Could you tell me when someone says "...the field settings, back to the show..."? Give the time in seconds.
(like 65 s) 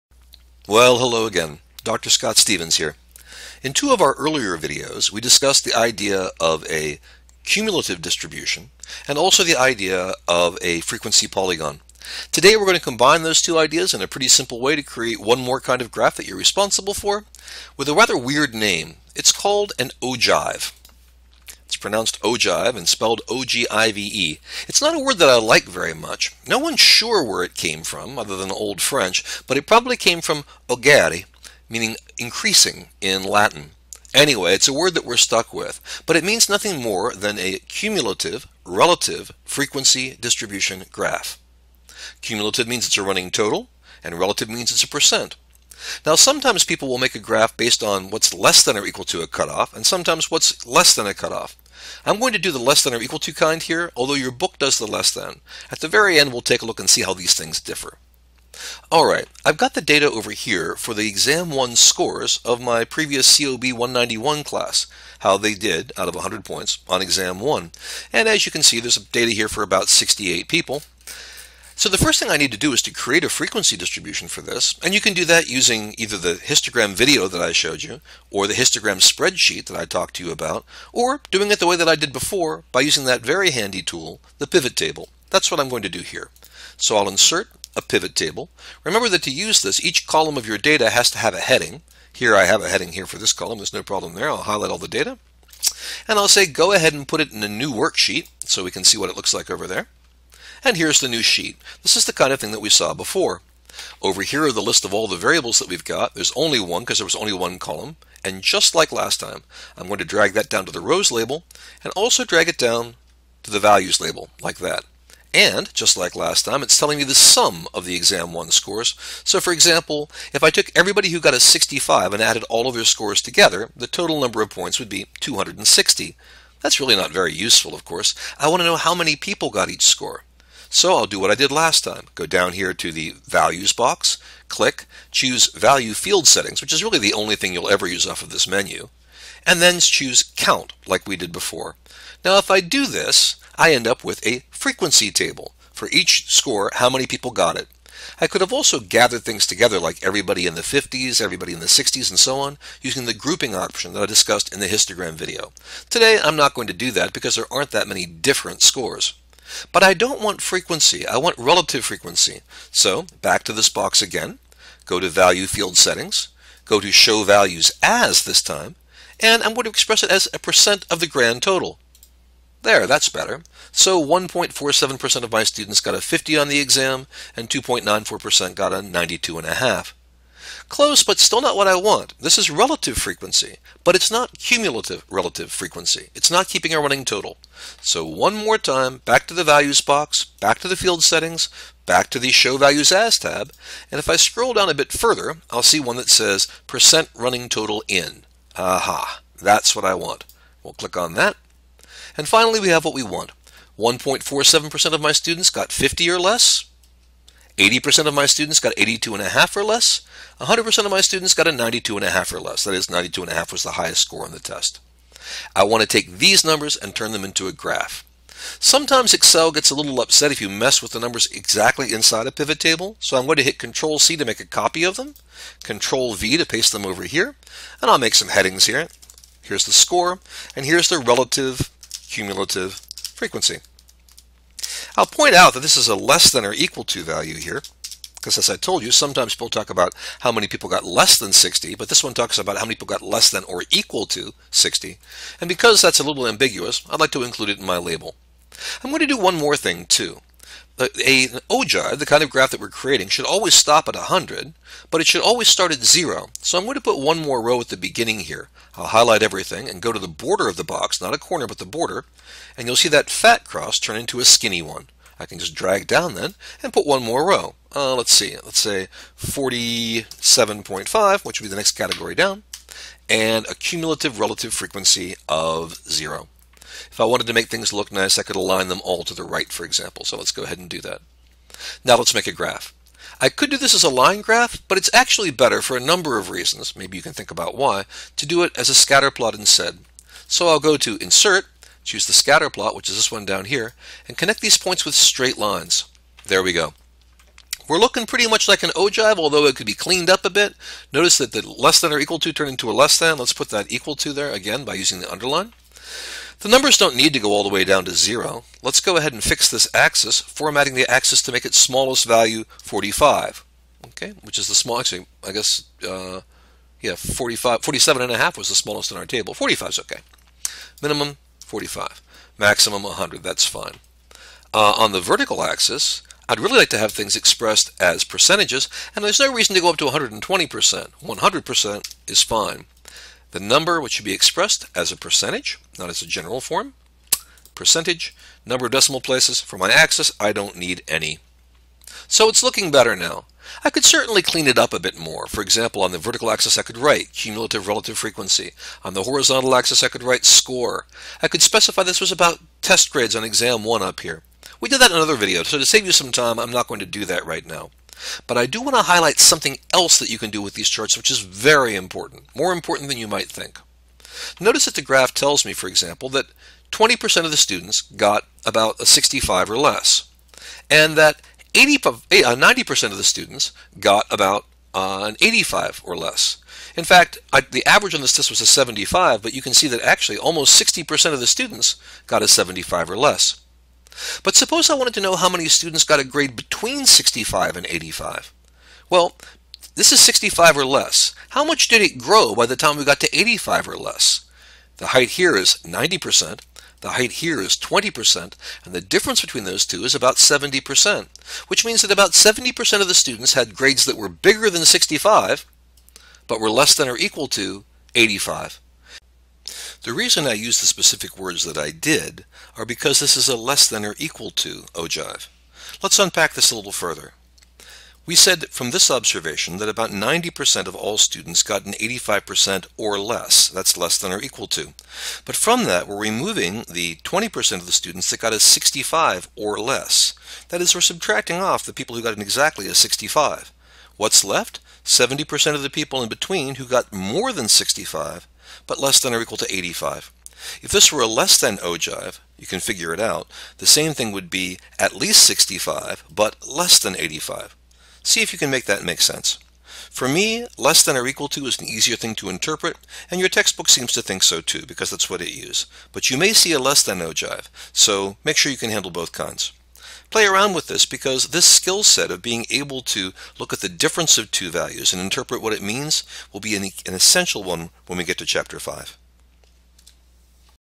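190 s.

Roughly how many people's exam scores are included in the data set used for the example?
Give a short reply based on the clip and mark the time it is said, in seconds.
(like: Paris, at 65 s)
68, at 69 s.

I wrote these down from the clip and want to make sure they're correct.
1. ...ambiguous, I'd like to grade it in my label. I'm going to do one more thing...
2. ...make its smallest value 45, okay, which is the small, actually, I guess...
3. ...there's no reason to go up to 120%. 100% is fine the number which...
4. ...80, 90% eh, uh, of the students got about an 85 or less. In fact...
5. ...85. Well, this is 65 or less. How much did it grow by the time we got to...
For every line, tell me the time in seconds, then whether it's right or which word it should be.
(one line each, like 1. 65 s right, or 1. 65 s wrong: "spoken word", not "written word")
1. 246 s wrong: "include", not "grade"
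2. 311 s right
3. 329 s right
4. 371 s right
5. 387 s right.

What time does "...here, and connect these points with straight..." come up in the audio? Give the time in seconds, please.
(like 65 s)
293 s.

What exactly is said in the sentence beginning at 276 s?
If I wanted to make things look nice, I could align them all to the right, for example.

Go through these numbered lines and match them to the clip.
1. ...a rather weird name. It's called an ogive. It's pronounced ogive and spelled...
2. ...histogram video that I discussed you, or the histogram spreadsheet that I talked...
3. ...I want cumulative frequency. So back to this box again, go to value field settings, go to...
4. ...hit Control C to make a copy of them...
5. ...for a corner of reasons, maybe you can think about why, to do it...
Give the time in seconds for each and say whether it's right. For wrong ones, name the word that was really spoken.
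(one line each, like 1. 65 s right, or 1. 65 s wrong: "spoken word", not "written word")
1. 17 s right
2. 76 s wrong: "showed", not "discussed"
3. 161 s wrong: "relative", not "cumulative"
4. 223 s right
5. 285 s wrong: "number", not "corner".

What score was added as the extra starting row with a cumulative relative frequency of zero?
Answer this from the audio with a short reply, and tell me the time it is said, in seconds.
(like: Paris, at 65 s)
47.5, at 269 s.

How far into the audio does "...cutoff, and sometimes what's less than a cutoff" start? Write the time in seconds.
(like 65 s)
49 s.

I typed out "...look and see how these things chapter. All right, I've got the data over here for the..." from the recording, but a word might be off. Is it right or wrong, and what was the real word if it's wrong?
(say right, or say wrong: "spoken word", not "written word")
wrong: "differ", not "chapter".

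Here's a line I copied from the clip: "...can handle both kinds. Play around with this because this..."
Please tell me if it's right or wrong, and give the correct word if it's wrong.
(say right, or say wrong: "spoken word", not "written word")
right.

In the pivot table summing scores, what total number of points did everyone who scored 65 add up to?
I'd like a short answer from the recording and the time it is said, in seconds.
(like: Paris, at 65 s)
260, at 125 s.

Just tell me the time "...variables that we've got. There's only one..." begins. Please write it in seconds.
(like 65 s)
105 s.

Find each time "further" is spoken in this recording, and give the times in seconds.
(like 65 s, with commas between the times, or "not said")
194 s, 416 s.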